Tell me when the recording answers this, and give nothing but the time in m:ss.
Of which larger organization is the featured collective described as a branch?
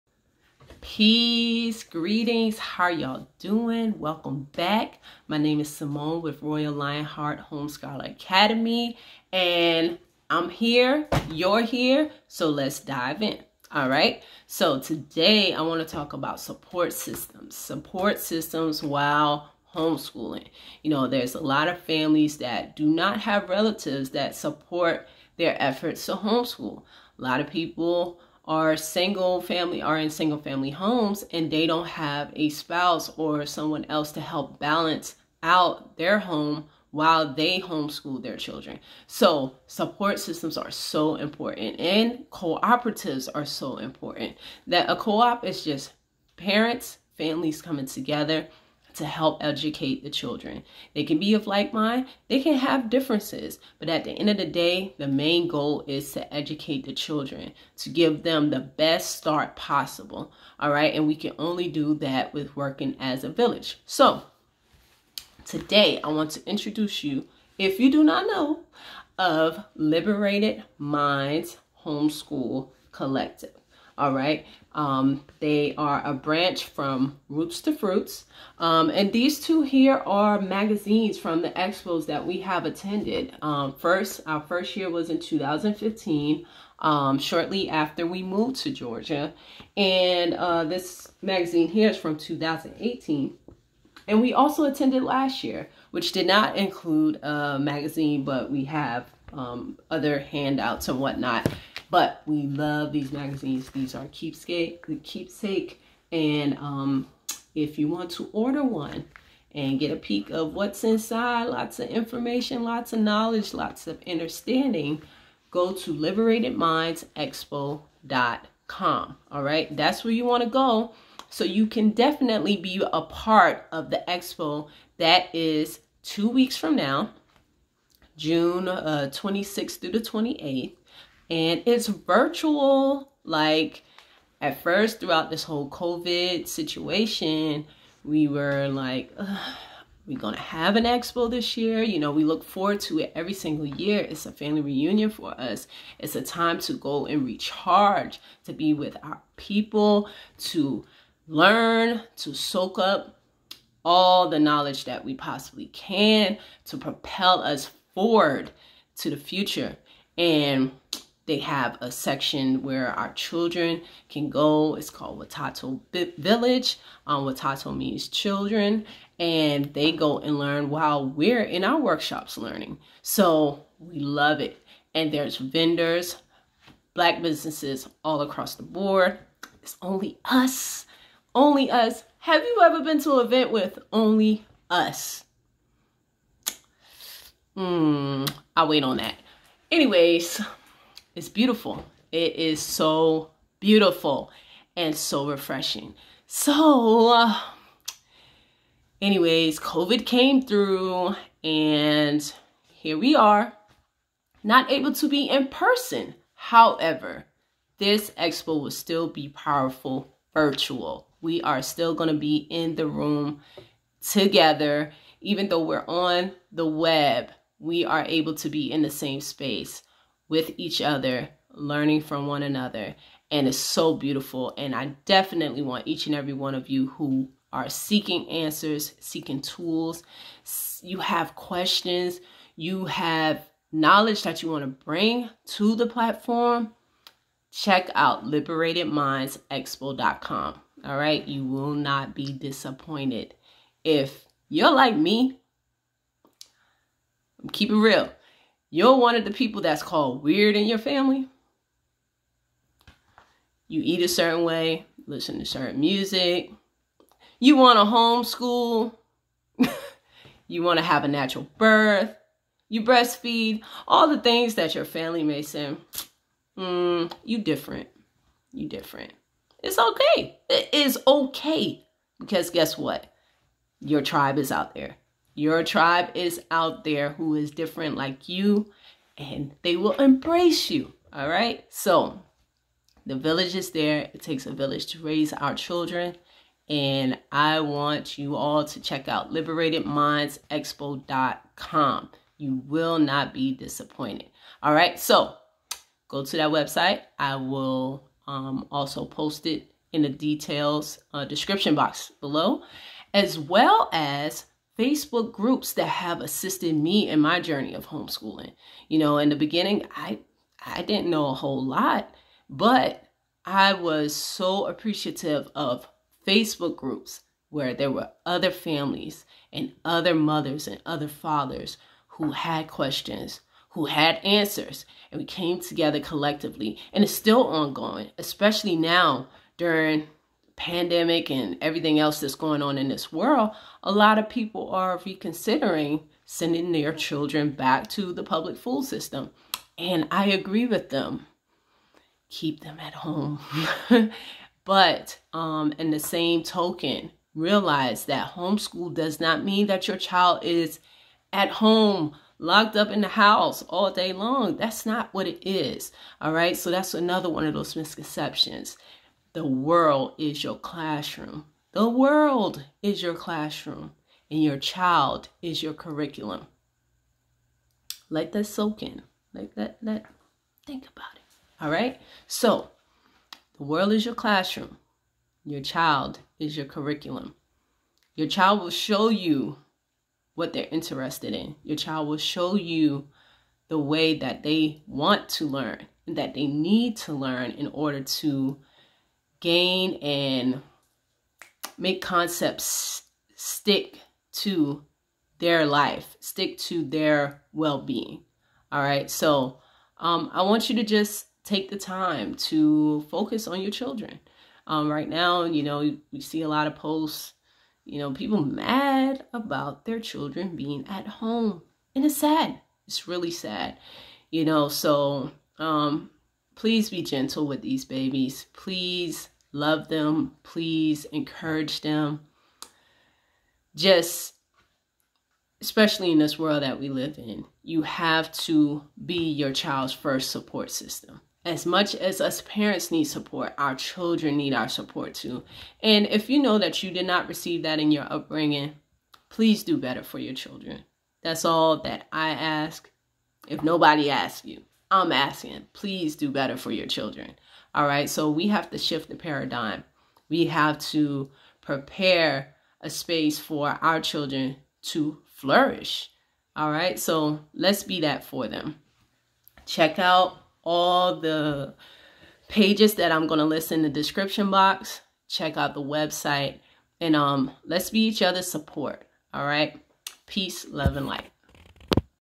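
1:17.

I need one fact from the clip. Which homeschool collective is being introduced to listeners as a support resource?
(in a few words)
Liberated Minds Homeschool Collective.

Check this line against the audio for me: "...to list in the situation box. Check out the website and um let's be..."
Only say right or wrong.
wrong.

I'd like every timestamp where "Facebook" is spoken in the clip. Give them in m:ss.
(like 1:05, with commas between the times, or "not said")
5:04, 5:16.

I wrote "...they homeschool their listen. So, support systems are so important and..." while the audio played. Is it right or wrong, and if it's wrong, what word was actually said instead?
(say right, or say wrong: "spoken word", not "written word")
wrong: "children", not "listen".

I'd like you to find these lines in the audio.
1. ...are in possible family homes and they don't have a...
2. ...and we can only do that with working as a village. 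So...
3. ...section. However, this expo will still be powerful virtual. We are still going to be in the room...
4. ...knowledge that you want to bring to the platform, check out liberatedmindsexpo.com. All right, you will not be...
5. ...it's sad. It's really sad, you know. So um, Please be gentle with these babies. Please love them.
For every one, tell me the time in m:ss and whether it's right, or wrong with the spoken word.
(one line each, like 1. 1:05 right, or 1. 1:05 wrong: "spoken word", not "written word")
1. 0:29 wrong: "single", not "possible"
2. 1:00 right
3. 3:25 wrong: "person", not "section"
4. 3:53 right
5. 6:52 right.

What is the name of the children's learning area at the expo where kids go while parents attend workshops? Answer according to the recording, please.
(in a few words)
Watoto Village.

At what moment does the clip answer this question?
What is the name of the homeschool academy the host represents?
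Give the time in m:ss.
0:06.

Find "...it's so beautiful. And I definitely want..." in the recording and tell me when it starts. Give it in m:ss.
3:43.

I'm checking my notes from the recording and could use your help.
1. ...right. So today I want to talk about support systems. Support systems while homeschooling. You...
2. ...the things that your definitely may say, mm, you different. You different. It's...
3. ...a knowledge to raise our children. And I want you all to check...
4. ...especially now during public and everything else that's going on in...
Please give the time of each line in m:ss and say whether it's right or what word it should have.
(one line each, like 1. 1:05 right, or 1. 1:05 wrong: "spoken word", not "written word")
1. 0:13 right
2. 4:24 wrong: "family", not "definitely"
3. 4:44 wrong: "village", not "knowledge"
4. 5:28 wrong: "pandemic", not "public".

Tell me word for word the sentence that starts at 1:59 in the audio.
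All right, that's where you want to go.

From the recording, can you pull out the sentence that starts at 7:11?
As much as us parents need support, our children need our support too.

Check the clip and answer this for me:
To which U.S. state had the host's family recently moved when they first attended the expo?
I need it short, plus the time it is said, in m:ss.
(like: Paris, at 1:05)
Georgia, at 1:28.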